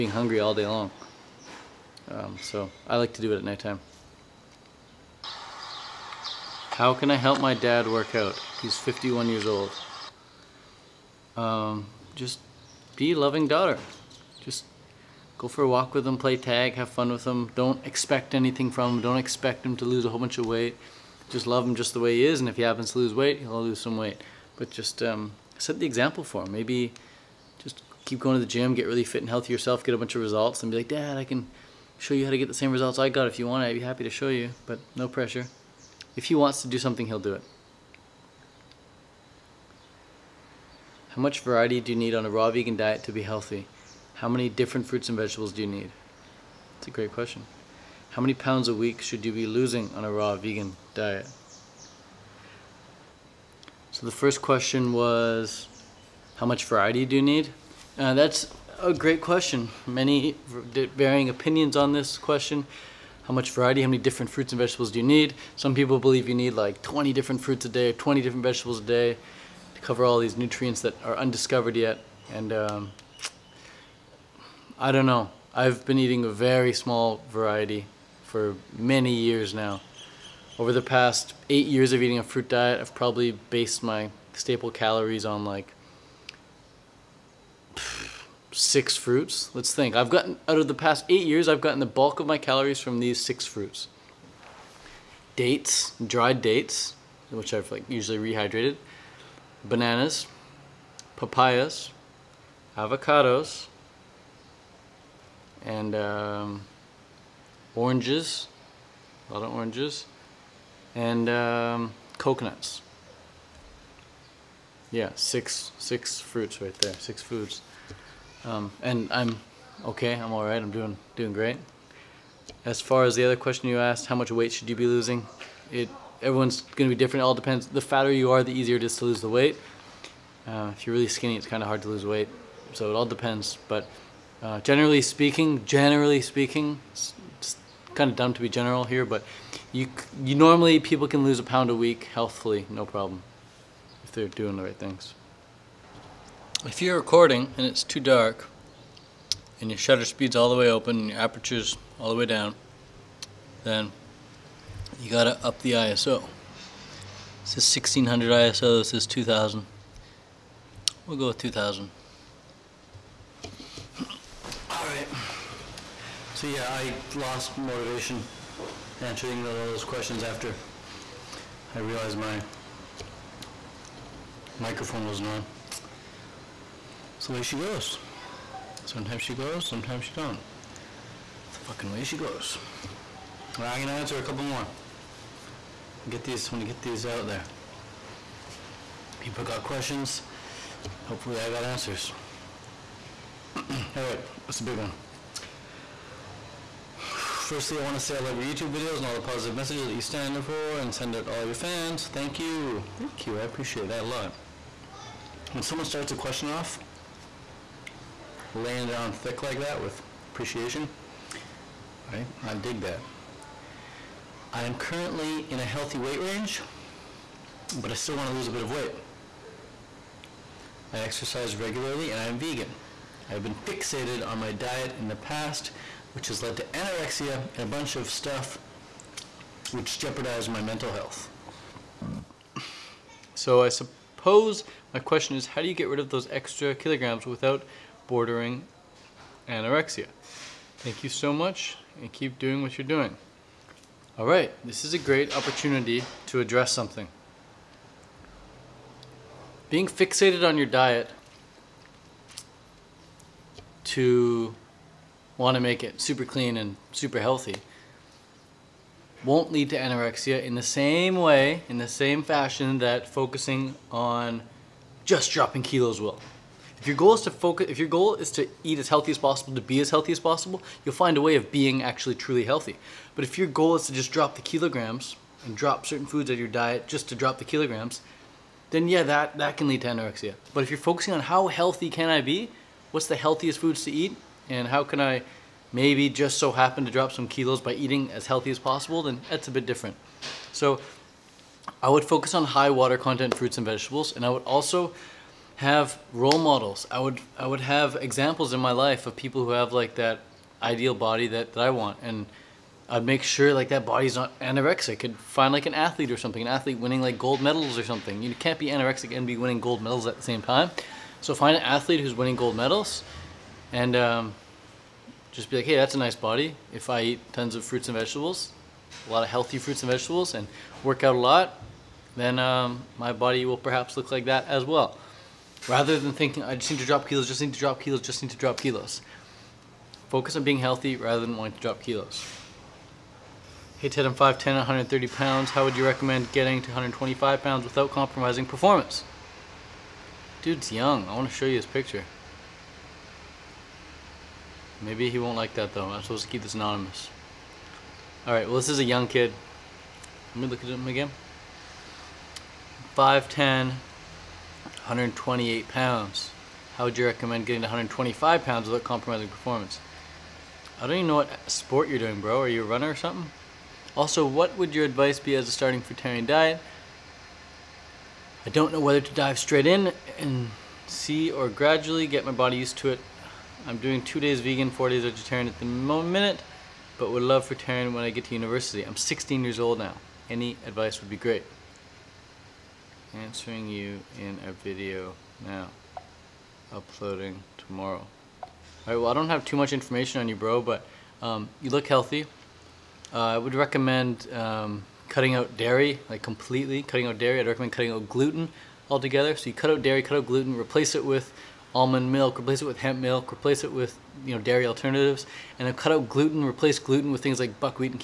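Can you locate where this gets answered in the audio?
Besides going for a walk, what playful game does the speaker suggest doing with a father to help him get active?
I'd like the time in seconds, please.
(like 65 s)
16 s.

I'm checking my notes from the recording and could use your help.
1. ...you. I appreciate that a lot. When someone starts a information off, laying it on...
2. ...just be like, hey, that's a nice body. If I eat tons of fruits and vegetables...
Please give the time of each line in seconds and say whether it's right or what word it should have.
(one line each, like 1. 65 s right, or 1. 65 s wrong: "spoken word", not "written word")
1. 203 s wrong: "question", not "information"
2. 315 s right.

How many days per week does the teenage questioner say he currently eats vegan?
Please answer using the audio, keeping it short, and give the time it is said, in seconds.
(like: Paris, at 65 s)
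2, at 374 s.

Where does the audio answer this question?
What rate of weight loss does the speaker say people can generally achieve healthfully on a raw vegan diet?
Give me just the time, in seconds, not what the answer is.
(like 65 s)
141 s.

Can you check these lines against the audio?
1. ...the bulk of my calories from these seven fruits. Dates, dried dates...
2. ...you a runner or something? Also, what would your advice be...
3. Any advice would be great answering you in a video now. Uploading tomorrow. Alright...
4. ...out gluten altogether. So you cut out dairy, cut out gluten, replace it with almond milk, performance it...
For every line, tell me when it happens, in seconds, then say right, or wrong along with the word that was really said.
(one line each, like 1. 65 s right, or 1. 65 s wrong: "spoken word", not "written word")
1. 91 s wrong: "six", not "seven"
2. 362 s right
3. 380 s right
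4. 397 s wrong: "replace", not "performance".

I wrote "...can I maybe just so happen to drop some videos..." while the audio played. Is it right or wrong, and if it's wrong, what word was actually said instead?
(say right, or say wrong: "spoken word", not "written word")
wrong: "kilos", not "videos".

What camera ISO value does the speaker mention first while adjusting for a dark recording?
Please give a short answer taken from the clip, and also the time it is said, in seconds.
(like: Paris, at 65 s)
1600, at 157 s.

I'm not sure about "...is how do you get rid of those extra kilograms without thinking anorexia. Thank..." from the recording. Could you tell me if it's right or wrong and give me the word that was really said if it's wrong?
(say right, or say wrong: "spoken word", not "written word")
wrong: "bordering", not "thinking".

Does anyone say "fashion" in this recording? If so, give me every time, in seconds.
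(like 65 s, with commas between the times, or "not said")
262 s.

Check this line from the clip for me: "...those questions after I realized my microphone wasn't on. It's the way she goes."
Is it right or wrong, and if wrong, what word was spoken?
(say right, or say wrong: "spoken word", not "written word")
right.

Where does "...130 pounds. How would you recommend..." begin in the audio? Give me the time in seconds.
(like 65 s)
334 s.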